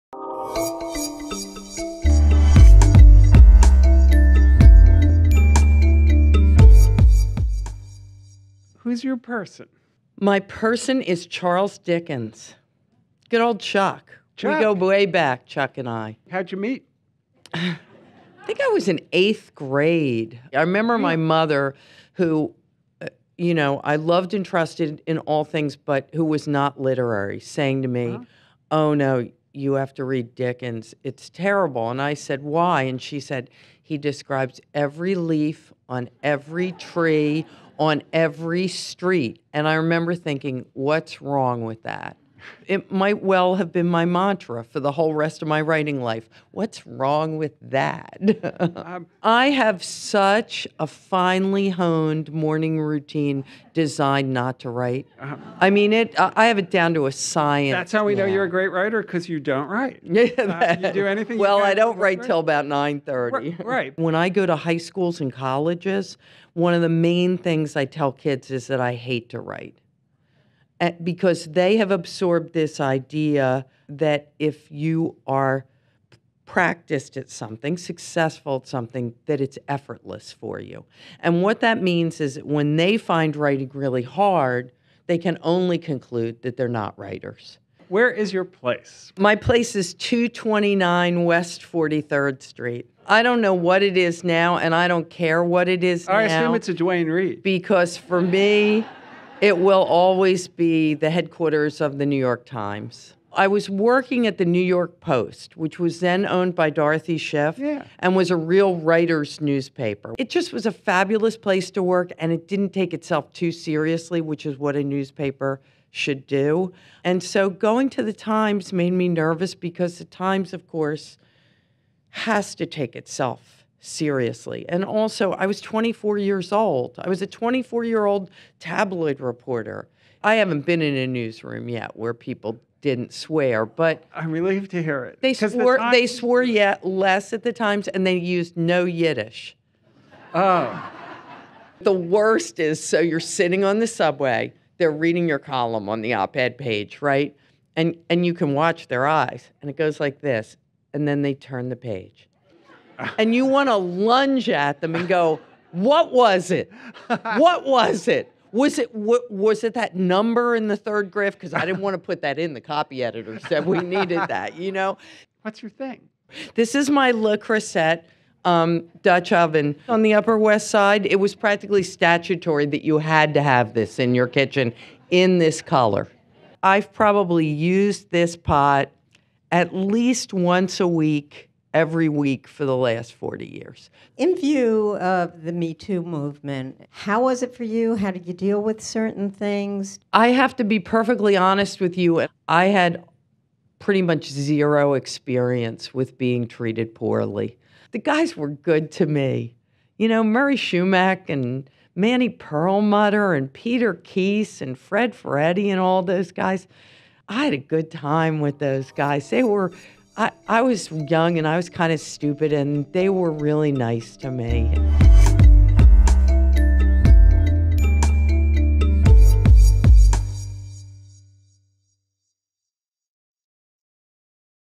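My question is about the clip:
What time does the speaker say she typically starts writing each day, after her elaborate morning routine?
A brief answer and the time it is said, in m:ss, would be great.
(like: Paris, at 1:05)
9:30, at 1:02.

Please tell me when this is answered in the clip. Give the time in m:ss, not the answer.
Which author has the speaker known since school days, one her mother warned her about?
0:11.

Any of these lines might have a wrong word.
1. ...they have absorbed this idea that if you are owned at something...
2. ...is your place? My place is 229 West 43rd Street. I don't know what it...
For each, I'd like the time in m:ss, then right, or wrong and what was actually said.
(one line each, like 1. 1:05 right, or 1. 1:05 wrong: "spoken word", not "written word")
1. 1:11 wrong: "practiced", not "owned"
2. 1:28 right.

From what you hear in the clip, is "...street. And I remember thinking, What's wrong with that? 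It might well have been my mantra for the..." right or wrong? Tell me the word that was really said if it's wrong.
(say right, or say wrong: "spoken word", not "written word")
right.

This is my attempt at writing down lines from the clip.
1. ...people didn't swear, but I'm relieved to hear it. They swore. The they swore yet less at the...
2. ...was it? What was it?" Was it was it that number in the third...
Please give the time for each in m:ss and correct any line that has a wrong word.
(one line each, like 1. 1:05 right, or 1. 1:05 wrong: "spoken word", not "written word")
1. 2:12 right
2. 2:36 right.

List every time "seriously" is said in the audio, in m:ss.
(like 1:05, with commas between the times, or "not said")
1:53, 2:03.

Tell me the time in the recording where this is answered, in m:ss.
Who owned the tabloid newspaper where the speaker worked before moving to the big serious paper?
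1:46.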